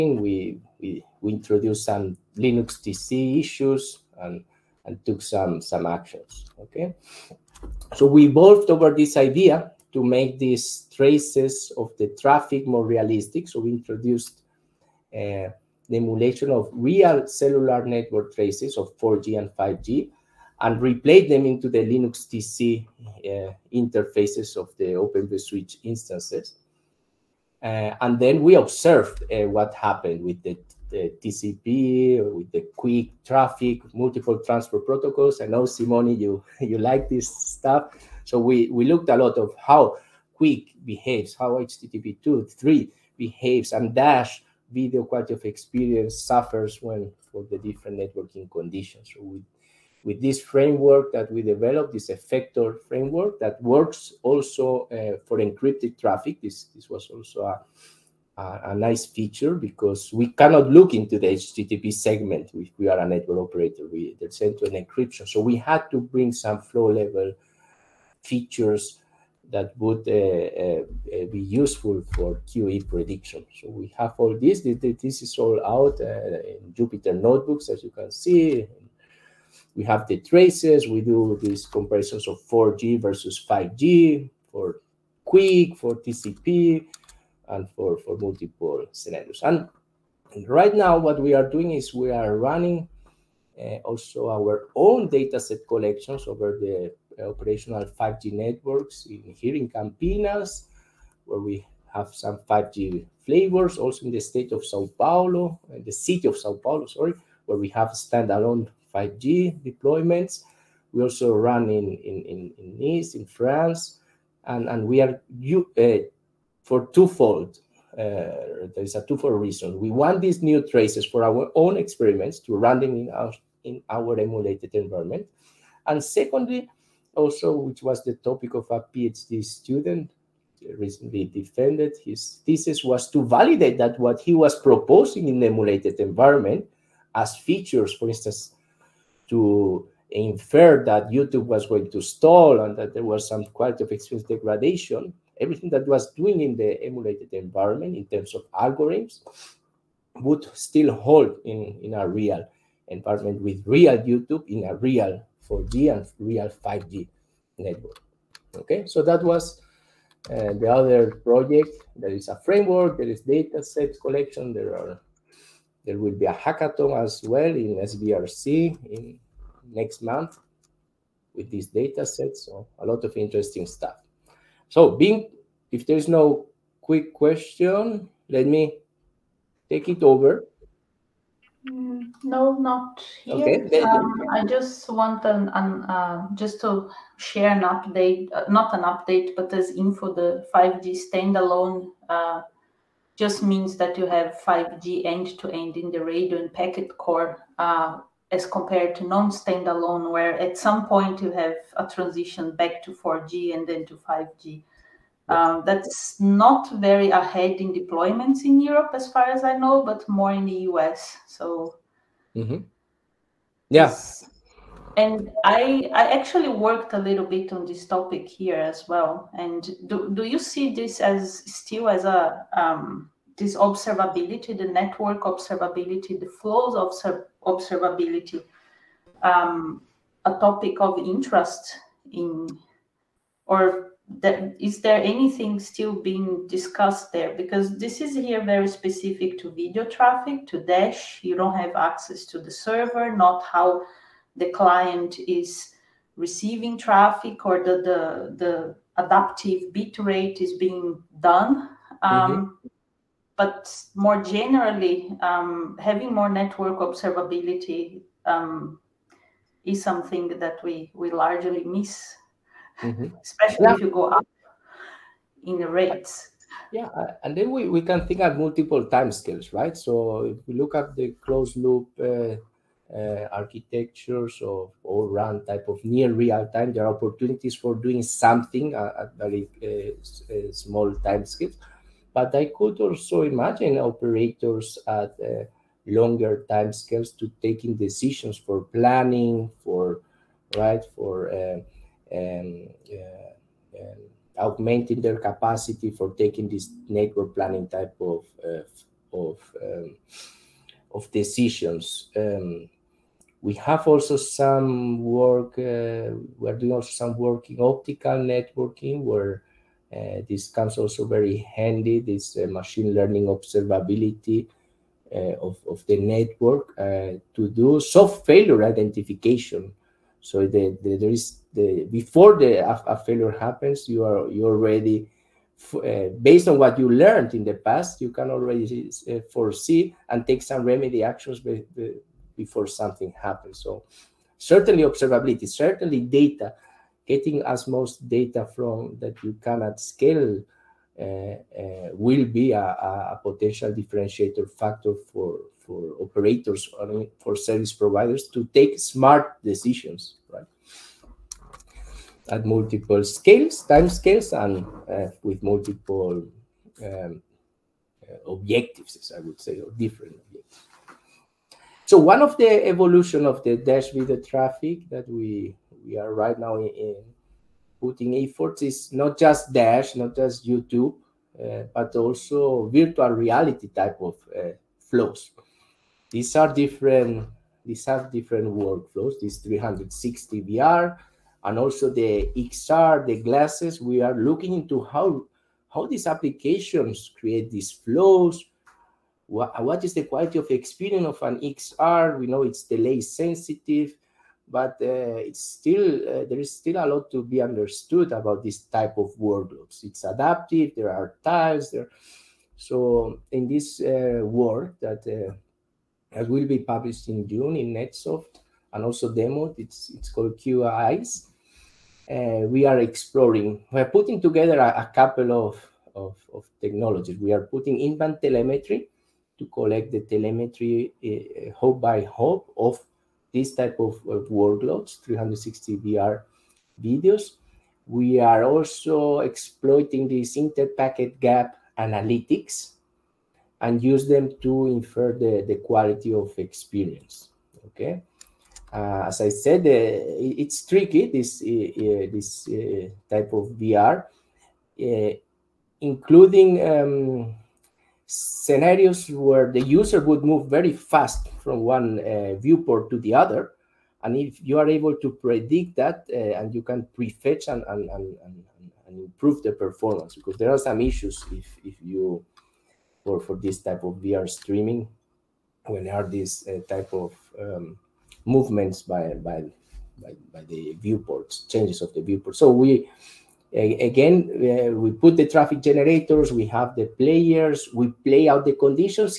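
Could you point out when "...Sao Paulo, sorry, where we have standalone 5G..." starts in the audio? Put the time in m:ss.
1:46.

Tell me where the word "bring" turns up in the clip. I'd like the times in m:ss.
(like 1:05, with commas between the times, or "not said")
1:05.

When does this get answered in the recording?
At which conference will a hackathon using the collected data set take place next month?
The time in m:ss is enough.
2:47.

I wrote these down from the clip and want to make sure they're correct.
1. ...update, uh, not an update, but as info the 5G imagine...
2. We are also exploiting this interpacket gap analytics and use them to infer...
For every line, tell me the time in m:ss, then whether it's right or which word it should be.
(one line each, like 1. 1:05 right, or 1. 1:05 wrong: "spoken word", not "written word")
1. 3:07 wrong: "standalone", not "imagine"
2. 7:07 right.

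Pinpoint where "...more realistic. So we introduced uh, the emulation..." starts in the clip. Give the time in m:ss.
0:12.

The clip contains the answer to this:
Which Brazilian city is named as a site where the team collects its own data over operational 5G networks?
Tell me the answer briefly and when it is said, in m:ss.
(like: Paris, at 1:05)
Campinas, at 1:39.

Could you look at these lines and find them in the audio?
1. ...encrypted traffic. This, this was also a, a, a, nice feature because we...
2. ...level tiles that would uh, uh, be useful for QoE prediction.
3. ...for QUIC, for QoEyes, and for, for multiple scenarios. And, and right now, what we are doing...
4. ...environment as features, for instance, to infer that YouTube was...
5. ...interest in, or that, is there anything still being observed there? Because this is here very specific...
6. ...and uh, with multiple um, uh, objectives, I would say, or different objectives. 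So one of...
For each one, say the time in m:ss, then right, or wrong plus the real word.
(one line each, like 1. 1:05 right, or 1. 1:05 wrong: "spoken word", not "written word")
1. 0:55 right
2. 1:06 wrong: "features", not "tiles"
3. 1:24 wrong: "TCP", not "QoEyes"
4. 2:15 right
5. 3:50 wrong: "discussed", not "observed"
6. 5:54 right.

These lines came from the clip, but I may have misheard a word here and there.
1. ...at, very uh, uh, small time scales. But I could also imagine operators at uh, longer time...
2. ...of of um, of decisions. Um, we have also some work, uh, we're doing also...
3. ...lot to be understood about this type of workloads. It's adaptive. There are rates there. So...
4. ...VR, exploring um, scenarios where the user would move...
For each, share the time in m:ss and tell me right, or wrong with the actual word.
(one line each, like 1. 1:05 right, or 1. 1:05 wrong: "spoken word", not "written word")
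1. 4:38 right
2. 4:58 right
3. 6:36 wrong: "tiles", not "rates"
4. 7:23 wrong: "including", not "exploring".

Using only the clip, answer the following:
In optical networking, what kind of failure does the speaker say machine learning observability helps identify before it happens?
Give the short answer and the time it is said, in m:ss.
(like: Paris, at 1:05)
soft failure, at 5:17.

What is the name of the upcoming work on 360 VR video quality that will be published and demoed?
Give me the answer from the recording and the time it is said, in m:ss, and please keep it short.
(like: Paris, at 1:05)
QoEyes, at 6:50.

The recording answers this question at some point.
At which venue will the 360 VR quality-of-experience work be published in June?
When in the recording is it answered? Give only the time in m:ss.
6:47.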